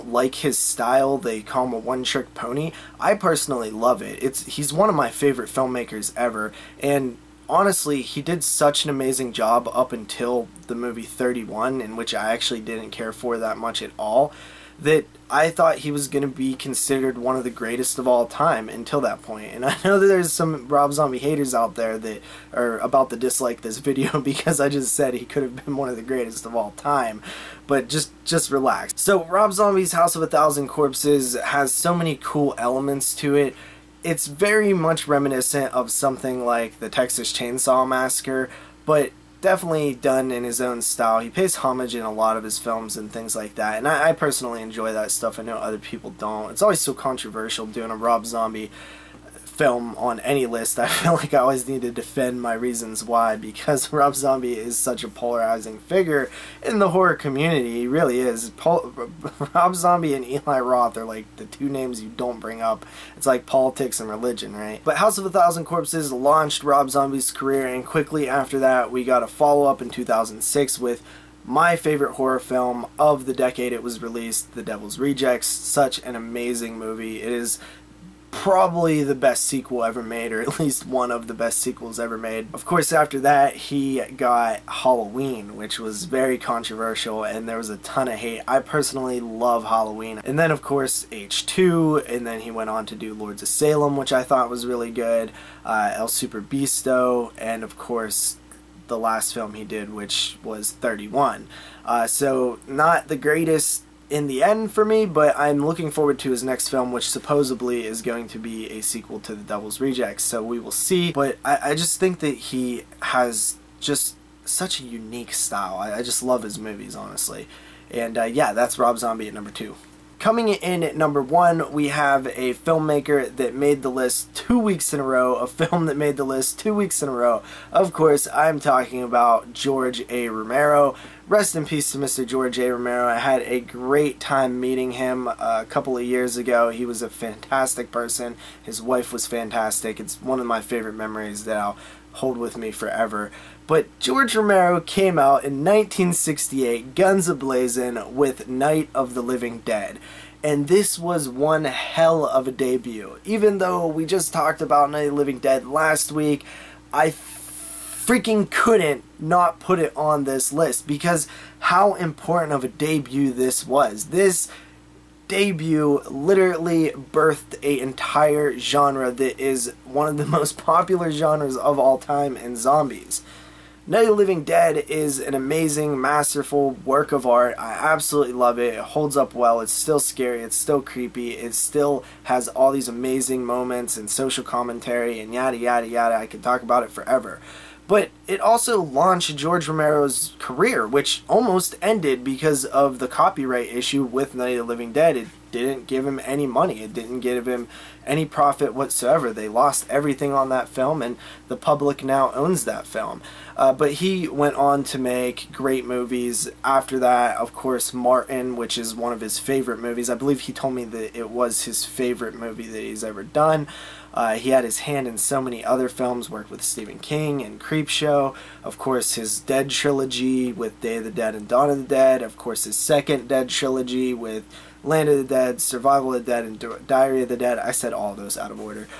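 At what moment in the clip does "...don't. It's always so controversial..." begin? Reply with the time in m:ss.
0:46.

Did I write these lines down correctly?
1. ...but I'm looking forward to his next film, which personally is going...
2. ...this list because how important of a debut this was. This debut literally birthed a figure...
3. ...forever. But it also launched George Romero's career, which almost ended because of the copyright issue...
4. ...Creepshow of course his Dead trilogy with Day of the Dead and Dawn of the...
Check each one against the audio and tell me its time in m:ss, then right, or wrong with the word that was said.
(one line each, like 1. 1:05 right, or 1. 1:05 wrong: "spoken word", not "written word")
1. 1:45 wrong: "supposedly", not "personally"
2. 2:40 wrong: "entire", not "figure"
3. 3:06 right
4. 3:37 right.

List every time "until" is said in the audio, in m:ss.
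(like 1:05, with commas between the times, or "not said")
0:09, 0:18.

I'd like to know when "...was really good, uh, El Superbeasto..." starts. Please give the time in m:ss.
1:34.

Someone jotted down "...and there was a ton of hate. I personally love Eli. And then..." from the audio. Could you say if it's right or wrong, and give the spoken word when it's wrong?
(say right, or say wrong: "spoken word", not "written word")
wrong: "Halloween", not "Eli".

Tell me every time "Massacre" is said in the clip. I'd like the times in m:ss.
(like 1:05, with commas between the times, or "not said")
0:37.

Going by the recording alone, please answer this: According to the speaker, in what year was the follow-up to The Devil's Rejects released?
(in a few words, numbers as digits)
2006.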